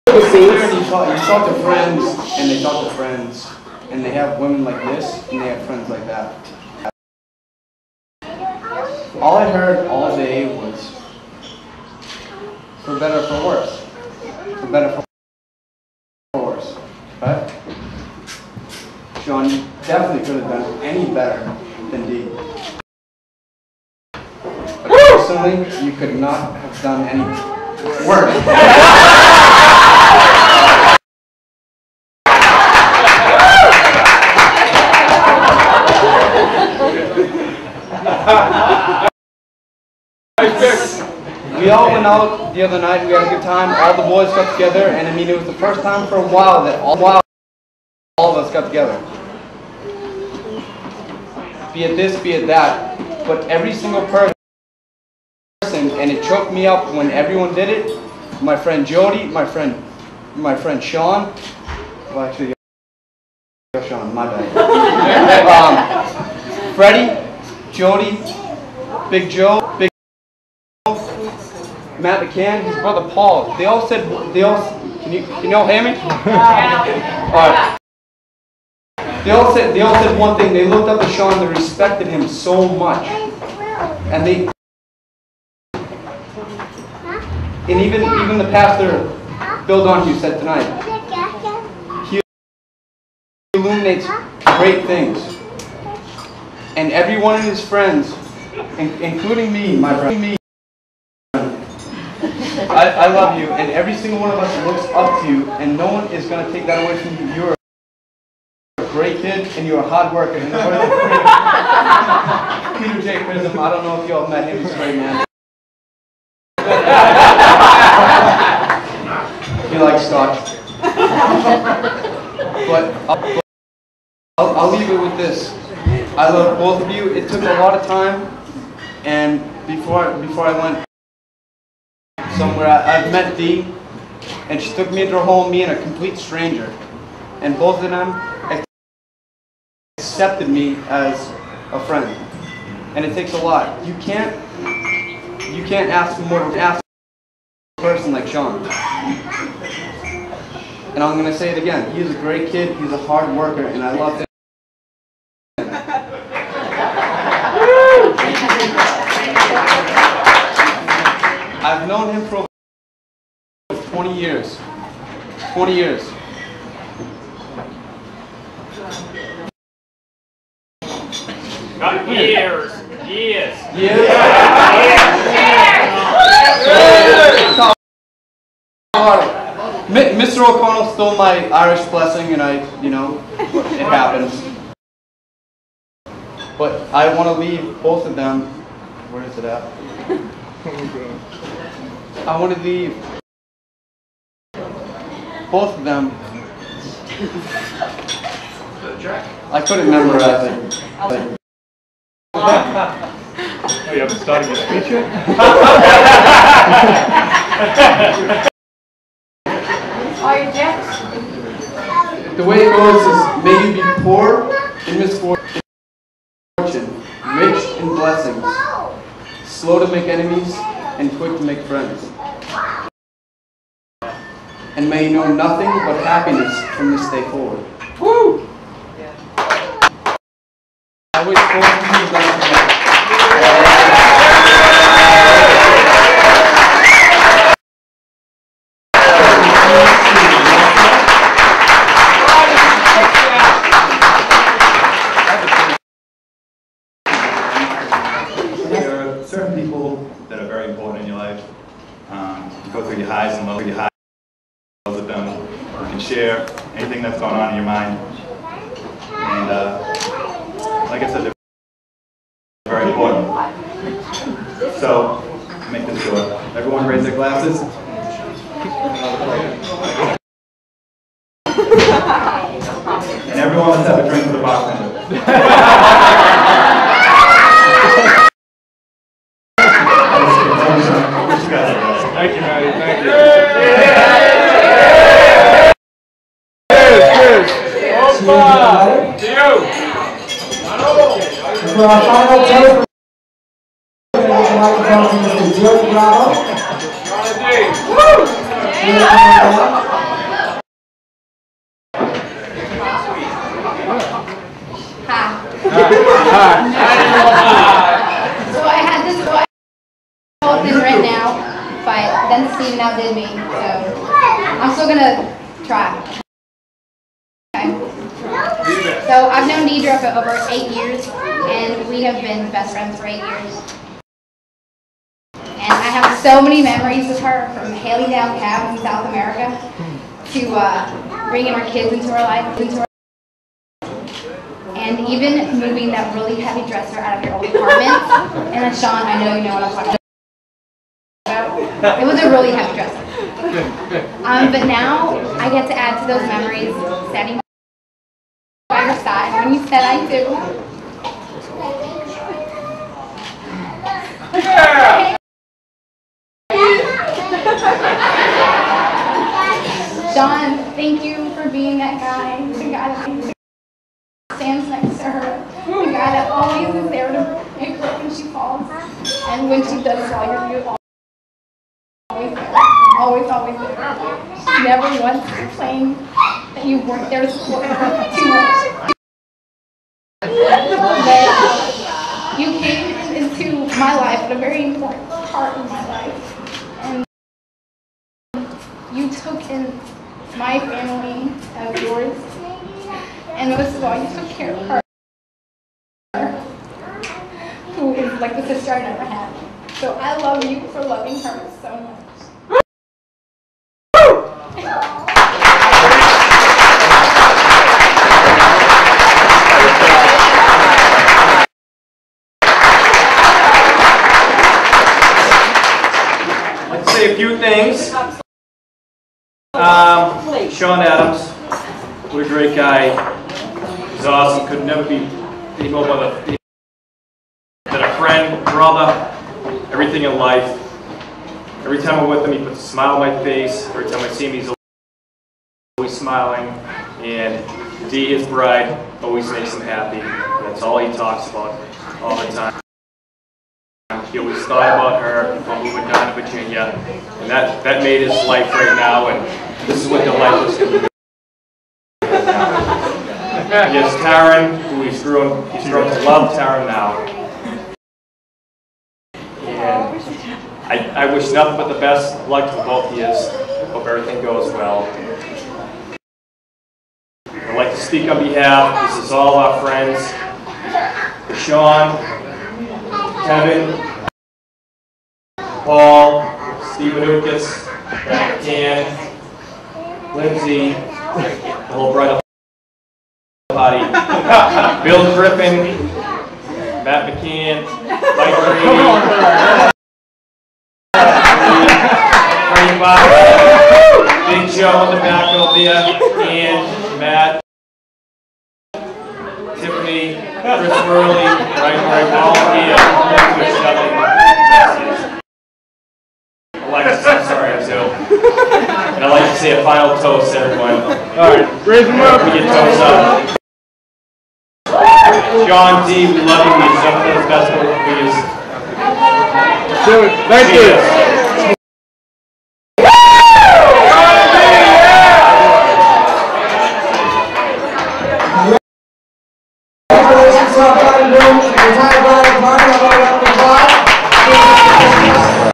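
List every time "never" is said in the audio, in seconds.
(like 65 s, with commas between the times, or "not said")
374 s, 398 s, 424 s.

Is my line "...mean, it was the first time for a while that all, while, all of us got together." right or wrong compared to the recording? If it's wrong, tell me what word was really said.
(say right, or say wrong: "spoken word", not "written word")
right.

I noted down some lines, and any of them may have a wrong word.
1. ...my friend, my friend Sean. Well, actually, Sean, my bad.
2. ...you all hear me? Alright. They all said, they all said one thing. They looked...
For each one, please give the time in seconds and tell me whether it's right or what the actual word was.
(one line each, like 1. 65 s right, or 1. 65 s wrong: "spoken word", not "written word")
1. 59 s right
2. 75 s right.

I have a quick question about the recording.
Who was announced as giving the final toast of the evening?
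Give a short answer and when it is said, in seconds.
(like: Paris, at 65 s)
Joe Bravo, at 295 s.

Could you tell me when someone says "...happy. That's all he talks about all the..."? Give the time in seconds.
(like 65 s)
439 s.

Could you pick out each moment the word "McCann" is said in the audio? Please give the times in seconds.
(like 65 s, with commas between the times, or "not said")
72 s, 487 s.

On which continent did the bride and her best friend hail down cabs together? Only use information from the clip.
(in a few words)
South America.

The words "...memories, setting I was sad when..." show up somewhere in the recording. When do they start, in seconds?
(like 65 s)
346 s.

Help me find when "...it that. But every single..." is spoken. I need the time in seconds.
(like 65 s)
52 s.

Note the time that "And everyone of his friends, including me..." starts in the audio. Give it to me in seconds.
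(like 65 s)
96 s.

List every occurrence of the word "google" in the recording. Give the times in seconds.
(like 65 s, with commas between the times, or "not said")
not said.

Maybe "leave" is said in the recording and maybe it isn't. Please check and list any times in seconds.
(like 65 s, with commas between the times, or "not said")
124 s, 187 s, 192 s.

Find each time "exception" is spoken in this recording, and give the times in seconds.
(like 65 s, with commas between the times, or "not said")
not said.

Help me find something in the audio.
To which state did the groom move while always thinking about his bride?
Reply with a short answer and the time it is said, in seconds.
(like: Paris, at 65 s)
Virginia, at 446 s.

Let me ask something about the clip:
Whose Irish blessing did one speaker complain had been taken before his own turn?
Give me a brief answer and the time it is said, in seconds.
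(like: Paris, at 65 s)
Mr. O'Connell, at 180 s.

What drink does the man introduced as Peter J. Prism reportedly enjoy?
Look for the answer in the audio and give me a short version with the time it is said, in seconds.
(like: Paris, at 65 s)
Scotch, at 120 s.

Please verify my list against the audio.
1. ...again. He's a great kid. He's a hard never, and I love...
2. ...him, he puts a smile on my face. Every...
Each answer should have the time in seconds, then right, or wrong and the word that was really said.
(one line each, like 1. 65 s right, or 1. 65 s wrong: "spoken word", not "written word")
1. 151 s wrong: "worker", not "never"
2. 432 s right.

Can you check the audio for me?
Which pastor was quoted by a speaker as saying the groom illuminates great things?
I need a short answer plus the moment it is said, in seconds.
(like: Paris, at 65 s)
Bill Donahue, at 89 s.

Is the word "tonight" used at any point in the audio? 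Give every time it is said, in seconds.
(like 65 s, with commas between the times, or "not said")
90 s.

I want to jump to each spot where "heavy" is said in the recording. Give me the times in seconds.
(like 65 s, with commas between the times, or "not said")
336 s, 342 s.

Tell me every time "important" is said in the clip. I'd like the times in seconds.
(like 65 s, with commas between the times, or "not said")
250 s, 262 s.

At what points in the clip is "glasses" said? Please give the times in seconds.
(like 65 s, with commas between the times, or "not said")
267 s.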